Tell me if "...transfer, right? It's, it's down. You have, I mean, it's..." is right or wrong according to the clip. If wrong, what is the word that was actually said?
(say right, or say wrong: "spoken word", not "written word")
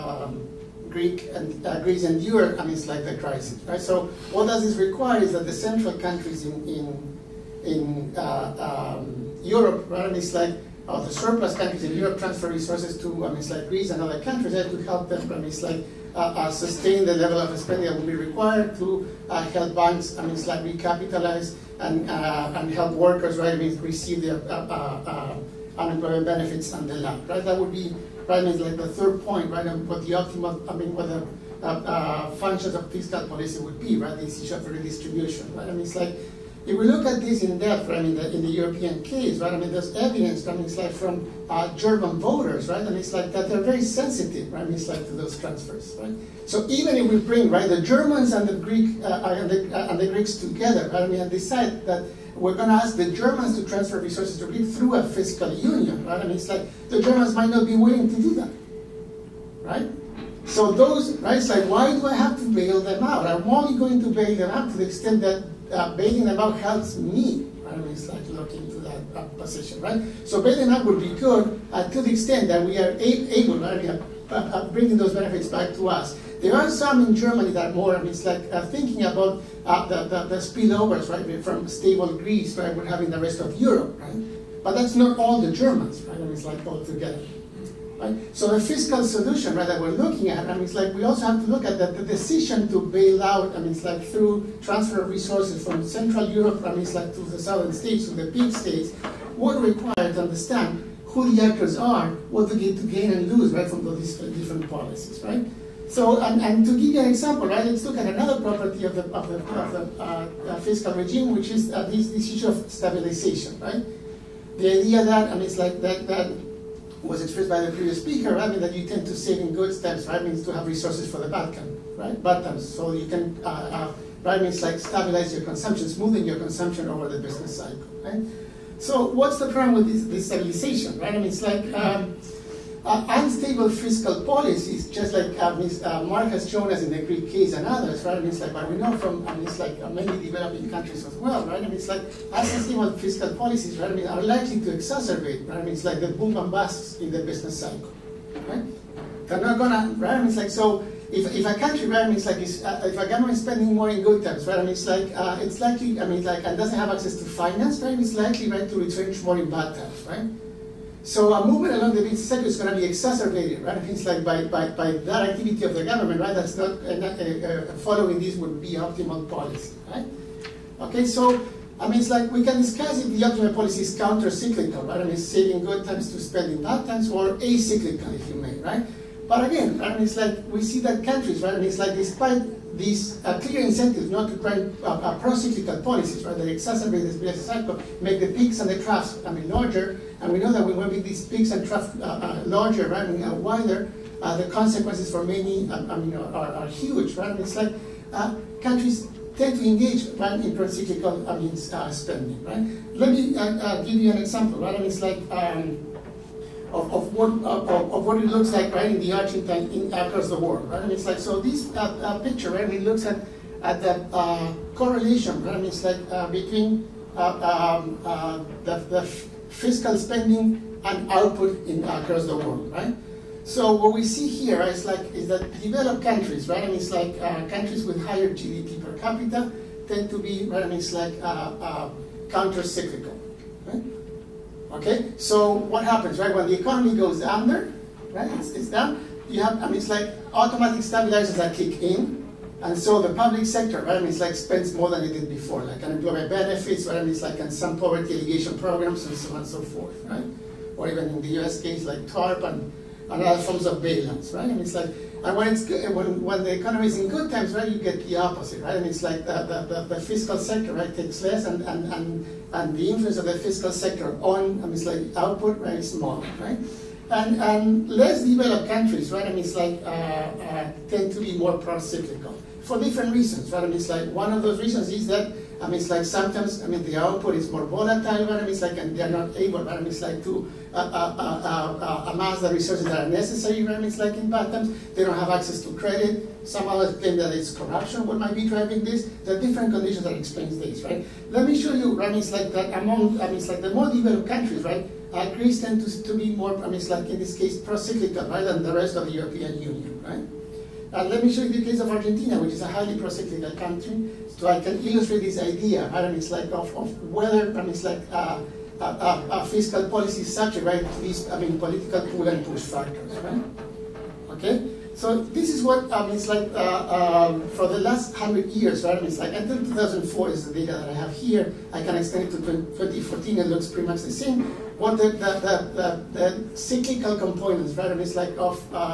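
wrong: "under", not "transfer".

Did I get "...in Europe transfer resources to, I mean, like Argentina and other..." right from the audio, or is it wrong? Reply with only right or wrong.
wrong.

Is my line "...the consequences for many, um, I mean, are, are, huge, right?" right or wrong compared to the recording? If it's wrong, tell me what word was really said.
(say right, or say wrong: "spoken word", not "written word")
right.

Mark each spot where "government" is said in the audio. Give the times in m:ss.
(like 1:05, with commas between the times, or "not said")
2:33, 2:45.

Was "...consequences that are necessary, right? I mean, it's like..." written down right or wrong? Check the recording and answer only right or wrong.
wrong.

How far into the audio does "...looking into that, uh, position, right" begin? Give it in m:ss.
1:08.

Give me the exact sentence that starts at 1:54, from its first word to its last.
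The idea that, I mean, it's like that, that was expressed by the previous speaker, right?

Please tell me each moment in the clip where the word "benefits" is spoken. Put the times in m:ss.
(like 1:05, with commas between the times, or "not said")
0:26, 1:15, 4:06.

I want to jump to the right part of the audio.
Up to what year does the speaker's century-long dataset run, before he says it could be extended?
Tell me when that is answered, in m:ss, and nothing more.
5:19.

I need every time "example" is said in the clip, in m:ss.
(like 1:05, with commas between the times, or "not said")
1:47, 3:24.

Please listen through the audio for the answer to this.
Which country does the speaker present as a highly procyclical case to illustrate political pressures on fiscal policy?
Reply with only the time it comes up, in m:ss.
5:01.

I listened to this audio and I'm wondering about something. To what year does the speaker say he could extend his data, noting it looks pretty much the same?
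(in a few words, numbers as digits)
2014.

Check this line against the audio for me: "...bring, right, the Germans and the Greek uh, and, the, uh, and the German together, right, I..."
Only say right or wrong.
wrong.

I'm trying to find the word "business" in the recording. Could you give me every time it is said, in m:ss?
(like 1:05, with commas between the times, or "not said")
2:07, 2:27, 2:42, 3:07.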